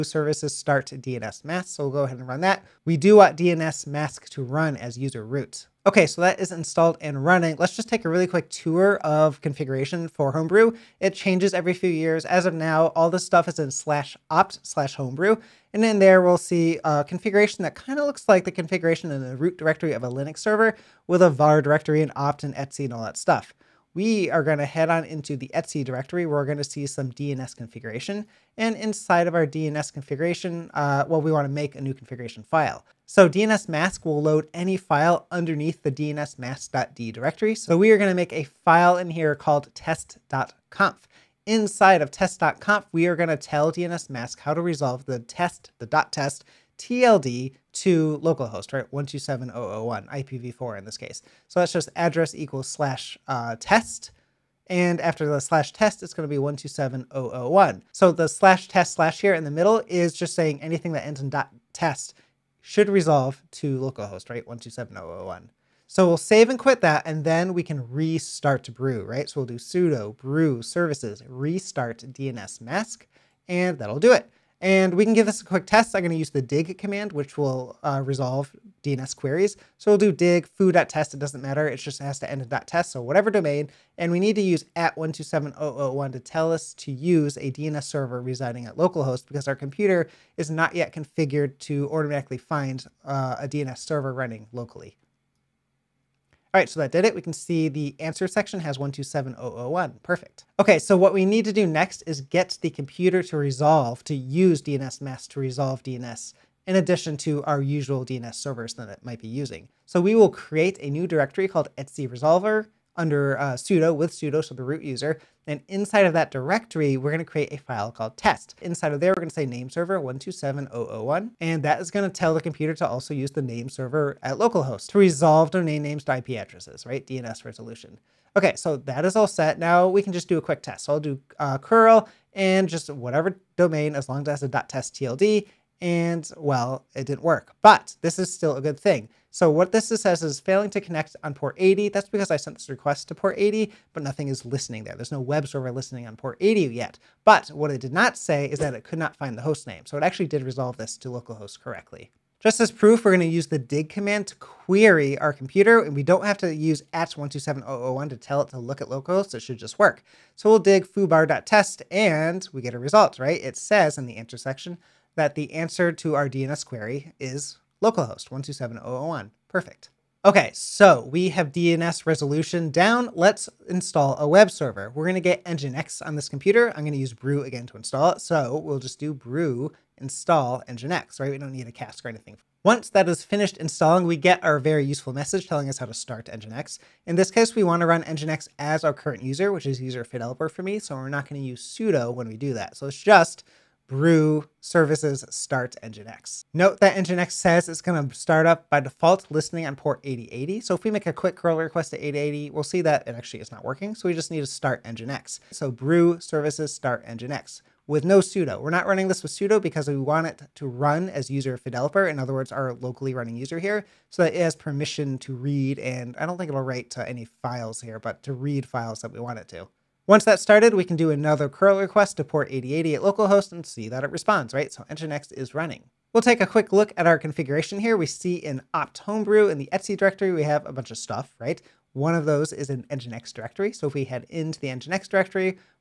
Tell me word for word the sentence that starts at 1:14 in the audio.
And we can give this a quick test.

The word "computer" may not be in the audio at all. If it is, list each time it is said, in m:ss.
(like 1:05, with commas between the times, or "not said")
1:29, 1:42, 2:02, 2:35, 2:56.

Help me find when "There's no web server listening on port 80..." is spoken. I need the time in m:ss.
2:24.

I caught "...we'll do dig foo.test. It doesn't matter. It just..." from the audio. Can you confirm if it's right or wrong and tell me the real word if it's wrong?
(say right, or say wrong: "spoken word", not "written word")
right.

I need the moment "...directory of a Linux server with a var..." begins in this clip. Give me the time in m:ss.
0:19.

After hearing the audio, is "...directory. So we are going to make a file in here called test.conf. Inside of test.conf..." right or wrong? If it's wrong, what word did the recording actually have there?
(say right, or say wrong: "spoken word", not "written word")
right.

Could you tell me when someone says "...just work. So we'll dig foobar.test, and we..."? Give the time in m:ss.
2:39.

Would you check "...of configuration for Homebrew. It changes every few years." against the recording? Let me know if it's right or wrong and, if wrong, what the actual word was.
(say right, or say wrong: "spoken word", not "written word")
right.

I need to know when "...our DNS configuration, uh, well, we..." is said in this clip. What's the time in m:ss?
0:29.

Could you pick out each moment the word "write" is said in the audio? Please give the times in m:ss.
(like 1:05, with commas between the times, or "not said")
3:36.